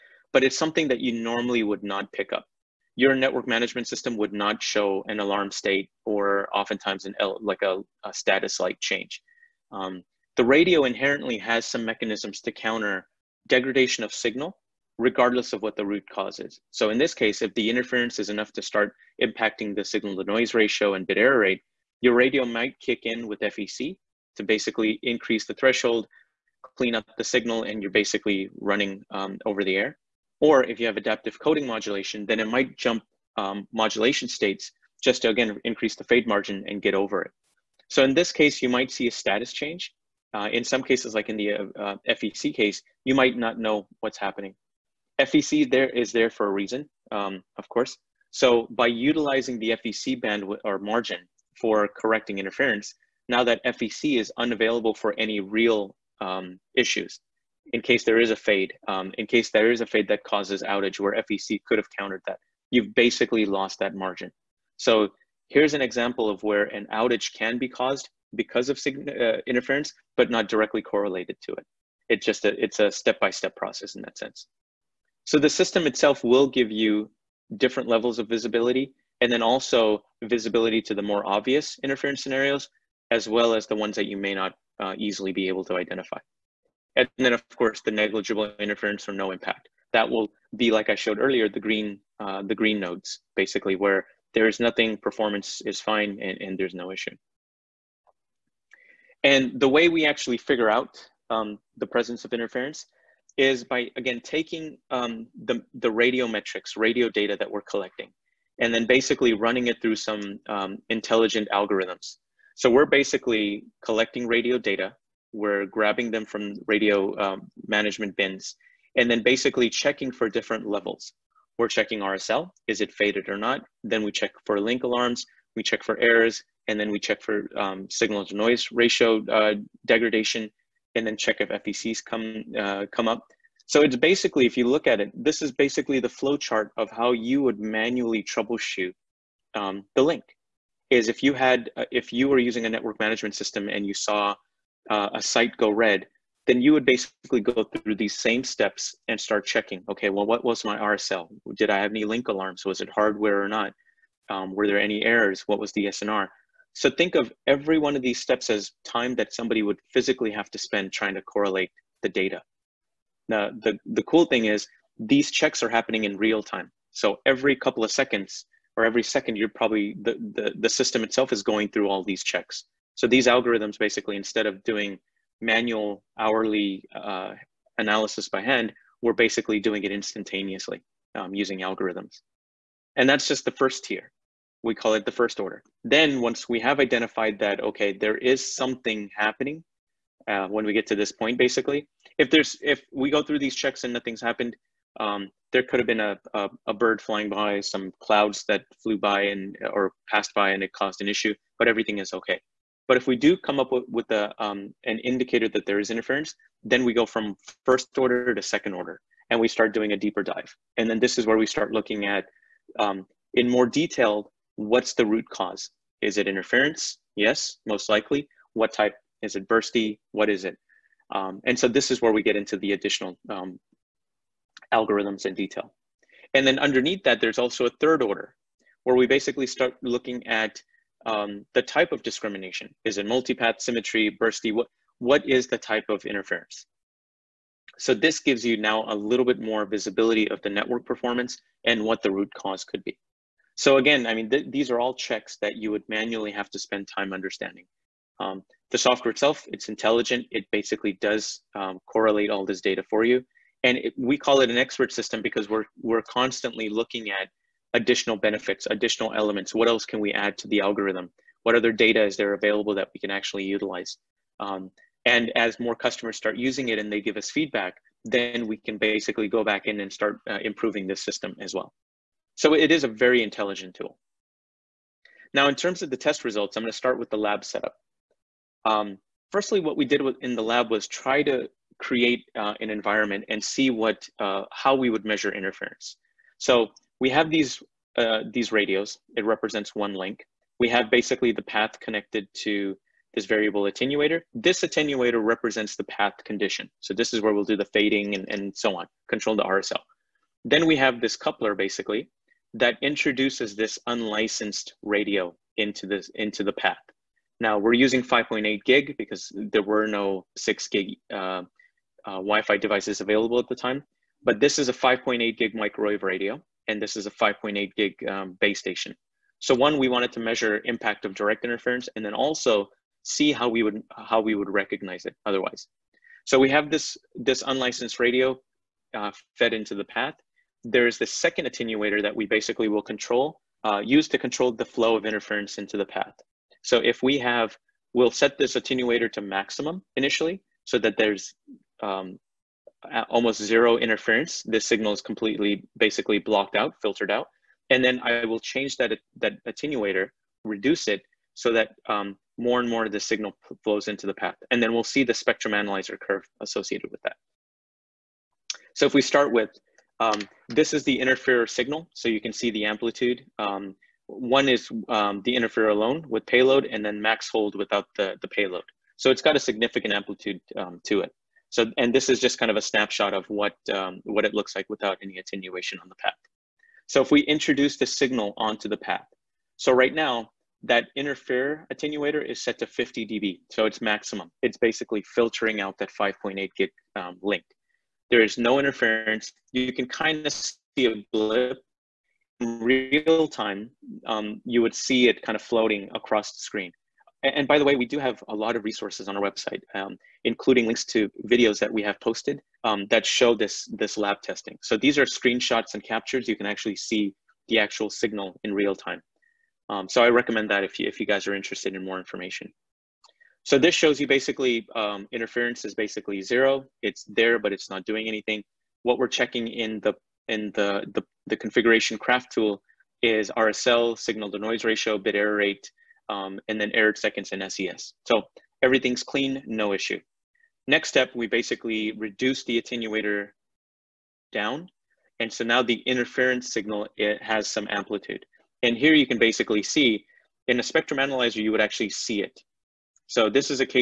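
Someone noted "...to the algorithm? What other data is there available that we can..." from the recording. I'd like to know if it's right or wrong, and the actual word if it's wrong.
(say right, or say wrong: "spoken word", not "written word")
right.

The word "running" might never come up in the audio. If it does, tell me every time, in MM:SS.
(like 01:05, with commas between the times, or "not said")
00:28, 01:49.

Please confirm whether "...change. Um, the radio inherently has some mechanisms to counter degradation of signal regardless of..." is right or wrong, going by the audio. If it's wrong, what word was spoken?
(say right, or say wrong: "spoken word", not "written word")
right.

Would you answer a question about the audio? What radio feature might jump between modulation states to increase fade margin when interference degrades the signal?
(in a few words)
adaptive coding modulation.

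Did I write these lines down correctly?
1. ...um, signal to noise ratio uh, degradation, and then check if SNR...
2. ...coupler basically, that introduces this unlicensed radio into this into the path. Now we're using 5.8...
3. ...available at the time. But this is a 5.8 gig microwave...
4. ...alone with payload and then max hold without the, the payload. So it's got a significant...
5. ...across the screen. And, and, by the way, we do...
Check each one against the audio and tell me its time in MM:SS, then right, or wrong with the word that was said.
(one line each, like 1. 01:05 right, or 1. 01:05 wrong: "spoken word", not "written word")
1. 02:07 wrong: "FECs", not "SNR"
2. 05:01 right
3. 05:13 right
4. 06:05 right
5. 06:35 right.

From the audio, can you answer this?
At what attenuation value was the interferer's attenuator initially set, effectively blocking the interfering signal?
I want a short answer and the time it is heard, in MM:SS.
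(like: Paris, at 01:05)
50 dB, at 06:22.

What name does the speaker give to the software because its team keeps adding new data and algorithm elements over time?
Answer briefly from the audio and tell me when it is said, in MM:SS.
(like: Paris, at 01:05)
expert system, at 04:14.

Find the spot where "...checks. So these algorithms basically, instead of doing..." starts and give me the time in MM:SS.
02:52.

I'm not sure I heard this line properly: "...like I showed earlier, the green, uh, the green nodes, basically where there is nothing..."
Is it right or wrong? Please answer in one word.
right.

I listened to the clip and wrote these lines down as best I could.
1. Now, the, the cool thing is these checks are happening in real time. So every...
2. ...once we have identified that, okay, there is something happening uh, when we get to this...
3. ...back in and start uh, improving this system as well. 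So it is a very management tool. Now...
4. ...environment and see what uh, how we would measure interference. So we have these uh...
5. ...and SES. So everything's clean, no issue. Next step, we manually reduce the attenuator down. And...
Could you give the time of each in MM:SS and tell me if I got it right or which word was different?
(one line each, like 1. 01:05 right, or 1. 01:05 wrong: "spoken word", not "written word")
1. 02:43 right
2. 03:06 right
3. 04:29 wrong: "intelligent", not "management"
4. 04:42 right
5. 07:07 wrong: "basically", not "manually".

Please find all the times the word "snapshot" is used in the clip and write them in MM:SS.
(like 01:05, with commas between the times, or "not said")
06:12.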